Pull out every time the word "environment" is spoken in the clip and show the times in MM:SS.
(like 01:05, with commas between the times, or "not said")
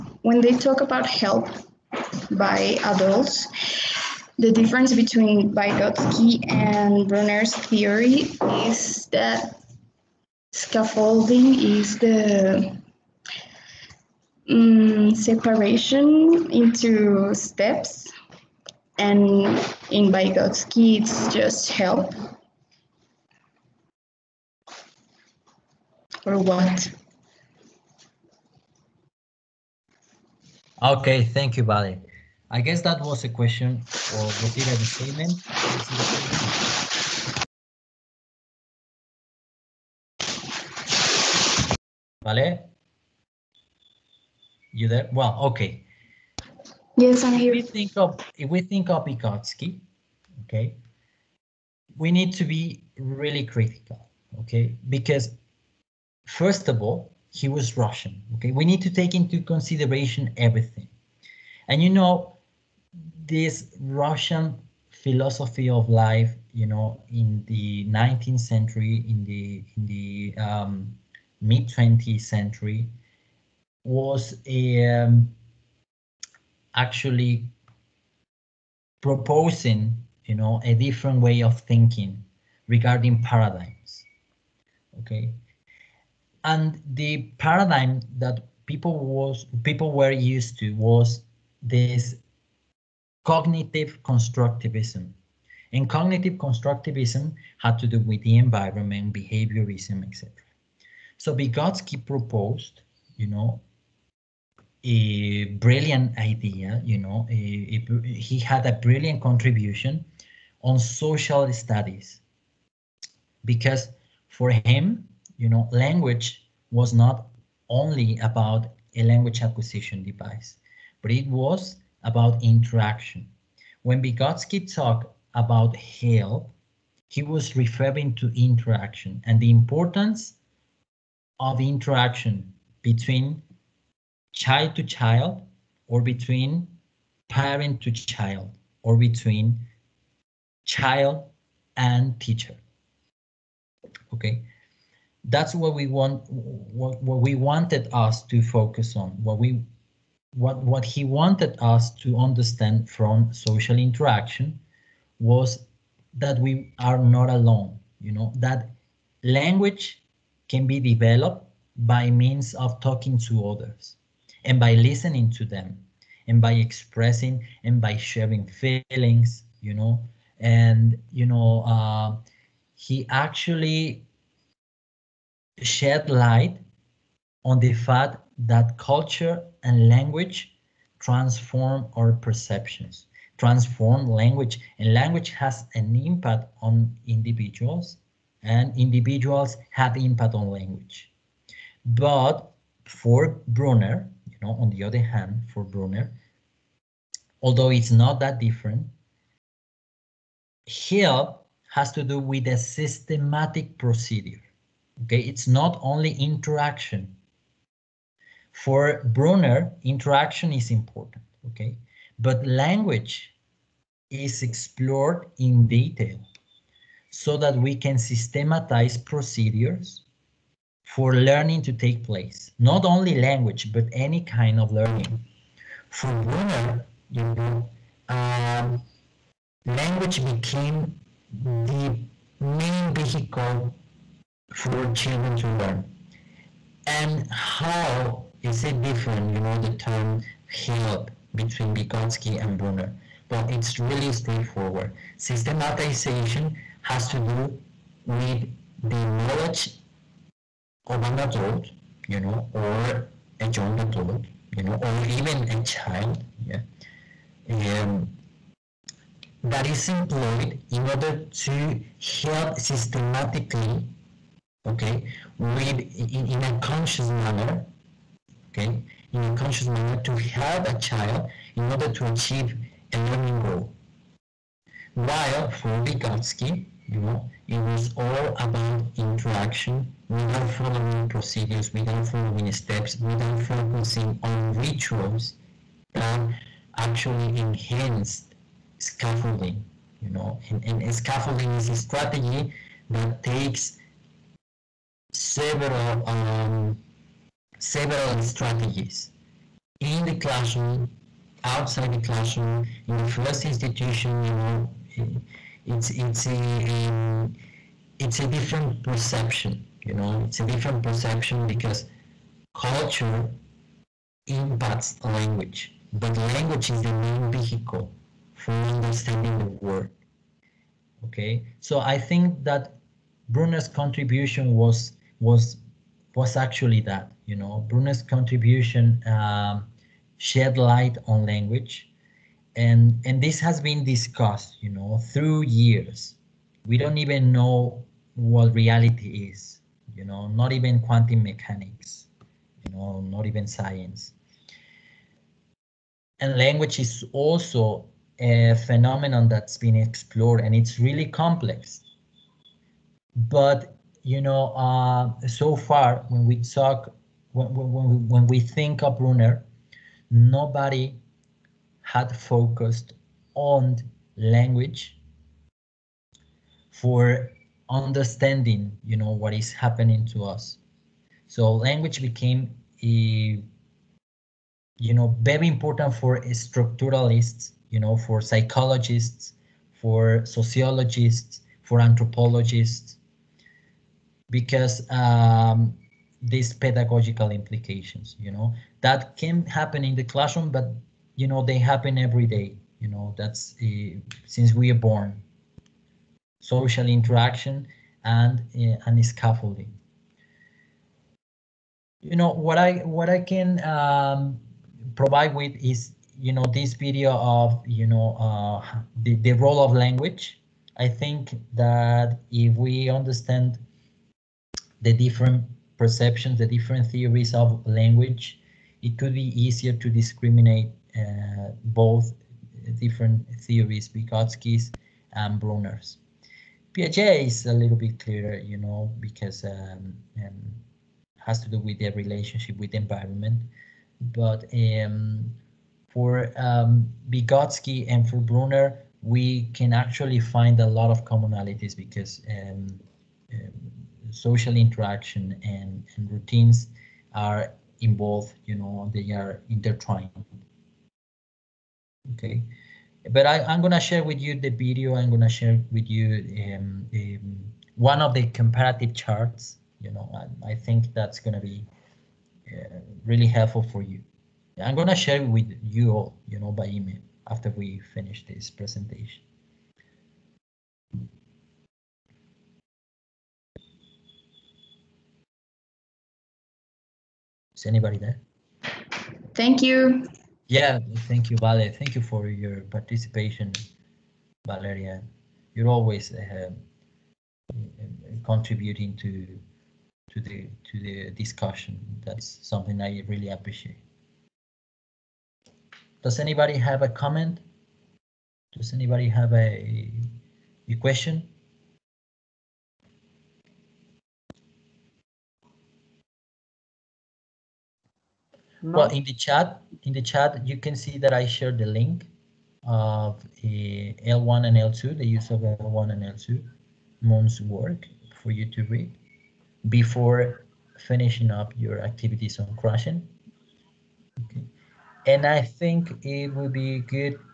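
01:38, 07:12.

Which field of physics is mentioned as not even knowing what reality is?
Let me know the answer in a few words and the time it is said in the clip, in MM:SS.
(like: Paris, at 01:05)
Quantum mechanics, at 05:40.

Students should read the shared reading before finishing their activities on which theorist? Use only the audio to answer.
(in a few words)
Krashen.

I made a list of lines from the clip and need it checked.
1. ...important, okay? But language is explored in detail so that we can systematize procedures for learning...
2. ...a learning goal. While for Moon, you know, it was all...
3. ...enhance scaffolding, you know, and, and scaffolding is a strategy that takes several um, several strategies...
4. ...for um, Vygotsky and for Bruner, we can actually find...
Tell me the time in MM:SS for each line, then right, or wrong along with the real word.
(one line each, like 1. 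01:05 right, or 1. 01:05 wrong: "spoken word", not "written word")
1. 03:30 right
2. 04:32 wrong: "Vygotsky", not "Moon"
3. 04:47 right
4. 07:15 right.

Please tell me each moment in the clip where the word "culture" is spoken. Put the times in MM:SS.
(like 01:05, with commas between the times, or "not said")
02:58, 05:12.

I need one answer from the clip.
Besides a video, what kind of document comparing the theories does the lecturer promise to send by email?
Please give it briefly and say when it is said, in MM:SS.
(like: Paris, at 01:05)
Comparative charts, at 07:38.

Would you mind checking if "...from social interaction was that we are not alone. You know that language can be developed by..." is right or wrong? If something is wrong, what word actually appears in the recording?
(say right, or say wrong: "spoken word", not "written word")
right.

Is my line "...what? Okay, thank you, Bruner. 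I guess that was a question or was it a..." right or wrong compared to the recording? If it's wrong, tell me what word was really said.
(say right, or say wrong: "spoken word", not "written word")
wrong: "Vale", not "Bruner".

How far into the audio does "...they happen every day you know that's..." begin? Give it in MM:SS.
06:31.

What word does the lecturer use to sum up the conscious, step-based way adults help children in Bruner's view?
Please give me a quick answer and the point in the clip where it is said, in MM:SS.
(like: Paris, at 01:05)
Systematization, at 04:05.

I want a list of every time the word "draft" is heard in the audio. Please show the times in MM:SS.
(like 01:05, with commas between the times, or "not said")
not said.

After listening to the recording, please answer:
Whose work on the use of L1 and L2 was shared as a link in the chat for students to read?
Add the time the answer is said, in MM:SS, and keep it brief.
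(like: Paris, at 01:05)
Moon, at 08:37.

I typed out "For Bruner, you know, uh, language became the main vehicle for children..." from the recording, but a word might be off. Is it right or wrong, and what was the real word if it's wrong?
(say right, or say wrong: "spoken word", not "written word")
right.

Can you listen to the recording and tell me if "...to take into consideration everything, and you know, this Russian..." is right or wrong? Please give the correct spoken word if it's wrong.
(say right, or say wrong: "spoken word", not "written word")
right.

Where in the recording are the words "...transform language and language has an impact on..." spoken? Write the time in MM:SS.
03:03.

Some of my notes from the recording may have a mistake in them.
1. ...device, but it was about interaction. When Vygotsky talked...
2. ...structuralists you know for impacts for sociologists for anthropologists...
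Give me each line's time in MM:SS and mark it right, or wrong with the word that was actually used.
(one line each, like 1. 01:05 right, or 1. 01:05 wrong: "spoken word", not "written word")
1. 02:00 right
2. 06:16 wrong: "psychologists", not "impacts".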